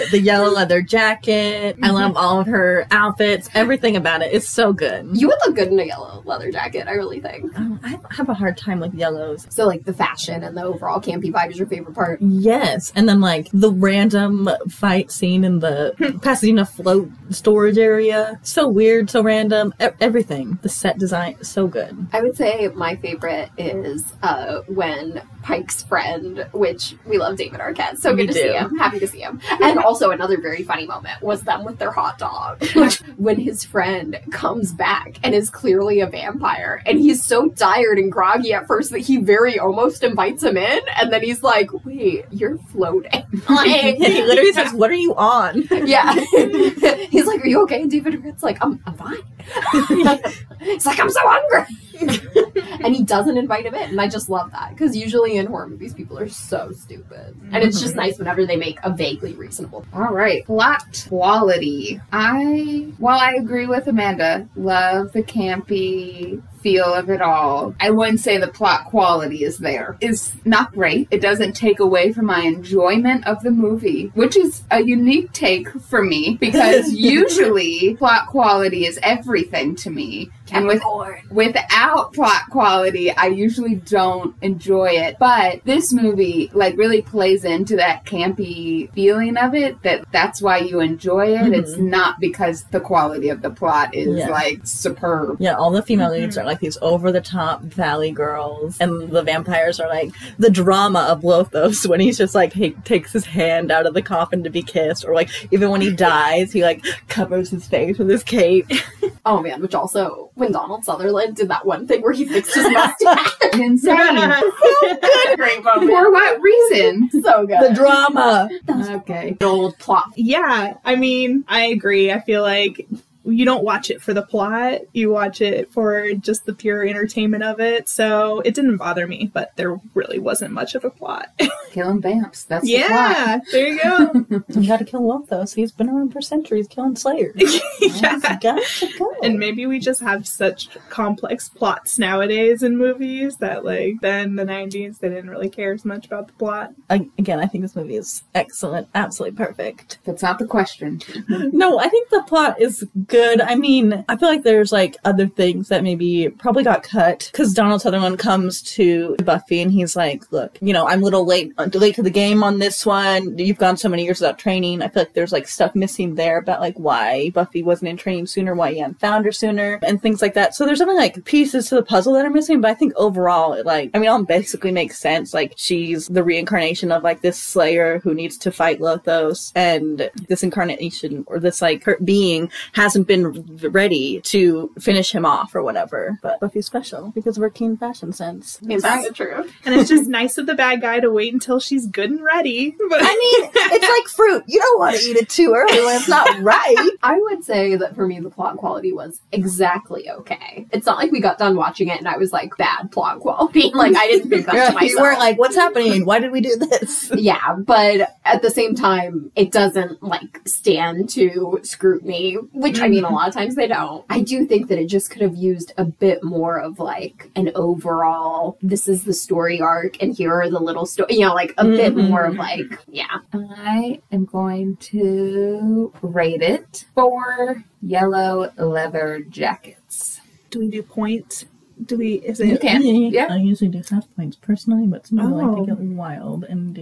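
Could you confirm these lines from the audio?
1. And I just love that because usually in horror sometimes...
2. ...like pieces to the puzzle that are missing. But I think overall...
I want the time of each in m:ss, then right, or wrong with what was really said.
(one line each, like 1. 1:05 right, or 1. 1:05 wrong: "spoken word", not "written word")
1. 0:53 wrong: "movies", not "sometimes"
2. 2:50 right.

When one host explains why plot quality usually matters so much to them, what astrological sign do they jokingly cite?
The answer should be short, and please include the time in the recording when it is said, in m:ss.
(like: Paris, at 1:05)
Capricorn, at 1:20.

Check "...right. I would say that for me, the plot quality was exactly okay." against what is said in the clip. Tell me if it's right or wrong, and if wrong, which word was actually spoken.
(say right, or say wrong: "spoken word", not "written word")
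right.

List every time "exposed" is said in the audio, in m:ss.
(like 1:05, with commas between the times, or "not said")
not said.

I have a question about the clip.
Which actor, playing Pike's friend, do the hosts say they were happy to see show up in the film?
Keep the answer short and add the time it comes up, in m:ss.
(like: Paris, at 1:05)
David Arquette, at 0:27.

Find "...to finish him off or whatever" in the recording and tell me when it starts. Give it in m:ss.
3:04.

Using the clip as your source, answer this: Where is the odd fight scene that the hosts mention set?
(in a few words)
Pasadena float storage.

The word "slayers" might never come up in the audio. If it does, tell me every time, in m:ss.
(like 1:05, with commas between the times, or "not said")
2:16, 2:57.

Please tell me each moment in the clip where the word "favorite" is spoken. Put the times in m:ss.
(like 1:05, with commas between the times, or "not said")
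0:11, 0:22.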